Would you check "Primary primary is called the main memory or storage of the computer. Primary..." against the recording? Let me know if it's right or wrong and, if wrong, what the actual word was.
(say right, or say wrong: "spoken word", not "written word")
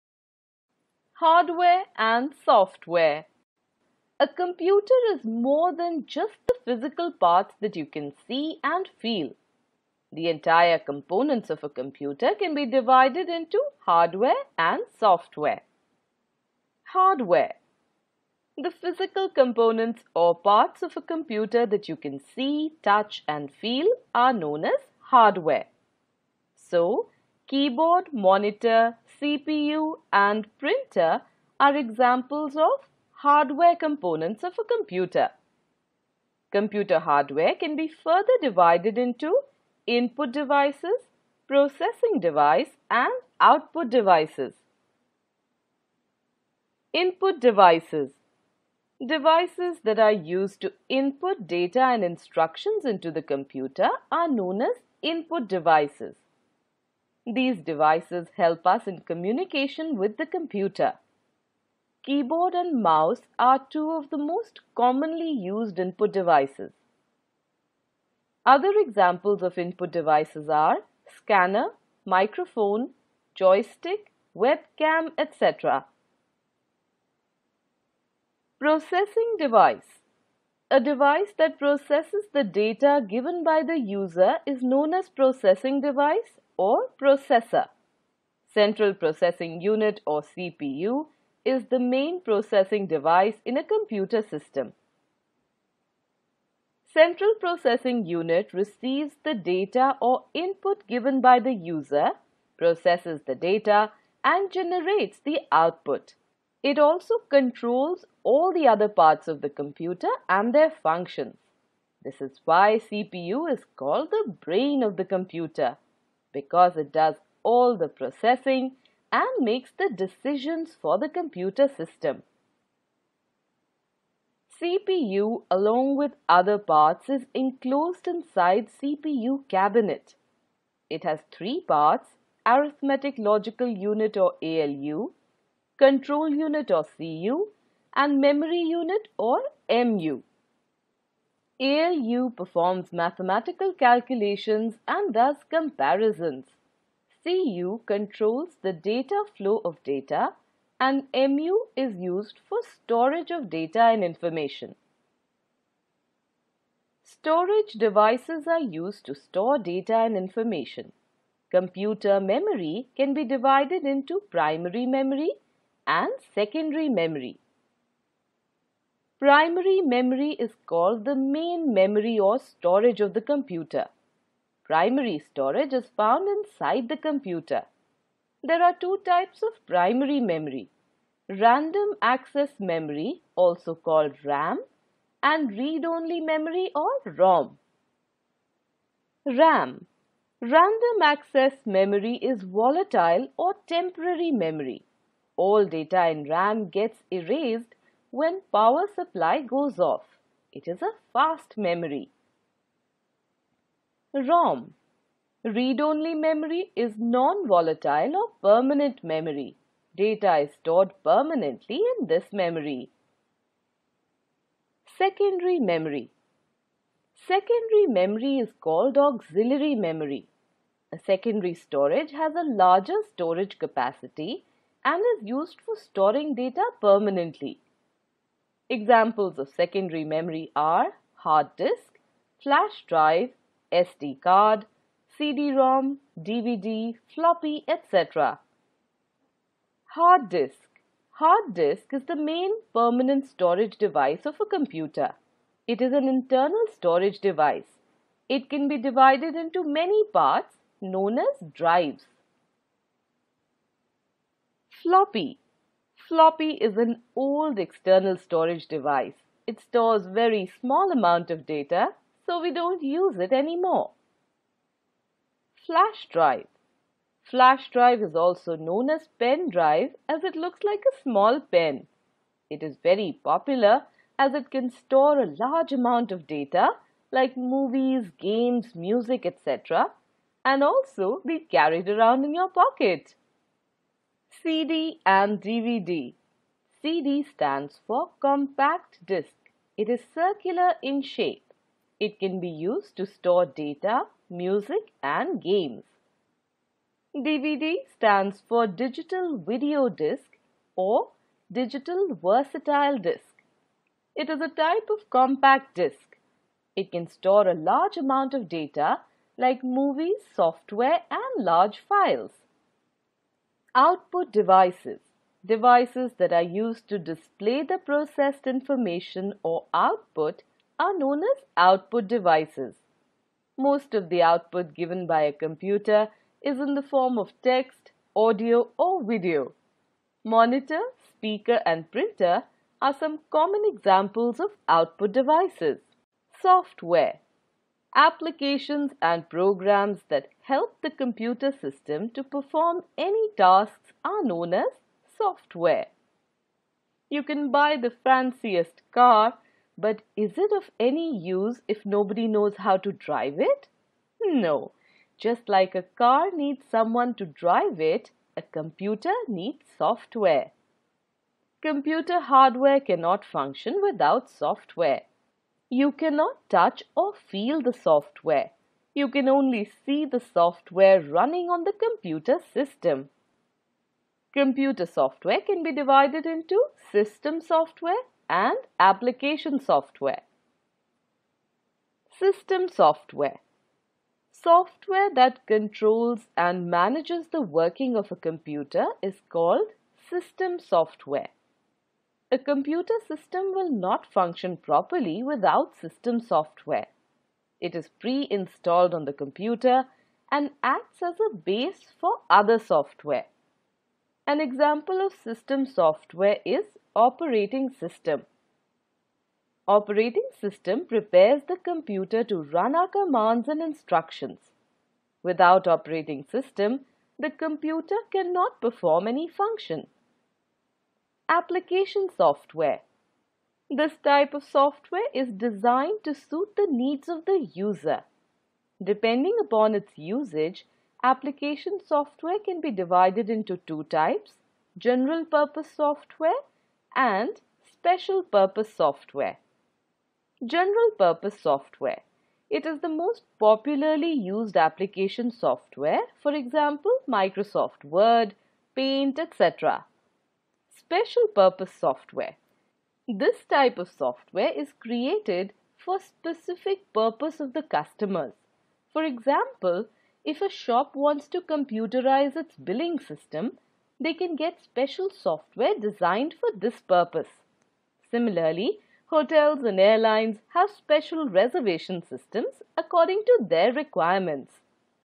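wrong: "memory", not "primary".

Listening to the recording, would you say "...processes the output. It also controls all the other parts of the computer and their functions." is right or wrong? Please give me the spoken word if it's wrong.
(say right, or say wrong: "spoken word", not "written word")
wrong: "generates", not "processes".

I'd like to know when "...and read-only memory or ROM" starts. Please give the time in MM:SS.
03:05.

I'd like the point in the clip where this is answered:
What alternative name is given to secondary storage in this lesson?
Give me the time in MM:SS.
03:38.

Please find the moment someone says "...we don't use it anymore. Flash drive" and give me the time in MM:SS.
04:22.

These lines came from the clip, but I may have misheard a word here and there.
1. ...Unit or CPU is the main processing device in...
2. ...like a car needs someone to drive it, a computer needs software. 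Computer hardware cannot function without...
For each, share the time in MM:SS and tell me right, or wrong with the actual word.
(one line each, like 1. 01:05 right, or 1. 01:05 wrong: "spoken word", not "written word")
1. 01:29 right
2. 05:55 right.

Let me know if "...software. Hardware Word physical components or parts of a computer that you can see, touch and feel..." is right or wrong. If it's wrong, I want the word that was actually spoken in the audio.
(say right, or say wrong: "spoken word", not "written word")
wrong: "The", not "Word".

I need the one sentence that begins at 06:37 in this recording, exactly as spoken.
It is pre-installed on the computer and acts as a base for other software.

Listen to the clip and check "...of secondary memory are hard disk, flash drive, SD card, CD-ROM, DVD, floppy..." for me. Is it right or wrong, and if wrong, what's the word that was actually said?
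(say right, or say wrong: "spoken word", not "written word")
right.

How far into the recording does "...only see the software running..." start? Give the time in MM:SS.
06:09.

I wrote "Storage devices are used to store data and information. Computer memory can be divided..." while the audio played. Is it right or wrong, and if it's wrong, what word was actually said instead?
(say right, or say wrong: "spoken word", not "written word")
right.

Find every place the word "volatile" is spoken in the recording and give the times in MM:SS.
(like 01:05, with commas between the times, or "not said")
03:12, 03:26.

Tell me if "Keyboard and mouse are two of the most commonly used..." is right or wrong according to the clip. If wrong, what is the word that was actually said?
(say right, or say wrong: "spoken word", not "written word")
right.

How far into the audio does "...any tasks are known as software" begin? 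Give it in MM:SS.
05:42.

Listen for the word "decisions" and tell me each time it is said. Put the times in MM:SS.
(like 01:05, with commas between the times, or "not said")
01:59.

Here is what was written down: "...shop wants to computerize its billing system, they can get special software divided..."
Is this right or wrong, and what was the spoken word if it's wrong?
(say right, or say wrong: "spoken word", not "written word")
wrong: "designed", not "divided".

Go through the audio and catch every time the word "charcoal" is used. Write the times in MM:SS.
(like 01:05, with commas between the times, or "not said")
not said.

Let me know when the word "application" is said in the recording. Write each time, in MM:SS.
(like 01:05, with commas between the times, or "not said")
05:37, 06:18, 07:01, 07:11, 07:24.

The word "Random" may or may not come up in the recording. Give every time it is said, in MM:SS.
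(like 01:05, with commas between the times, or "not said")
03:01, 03:10.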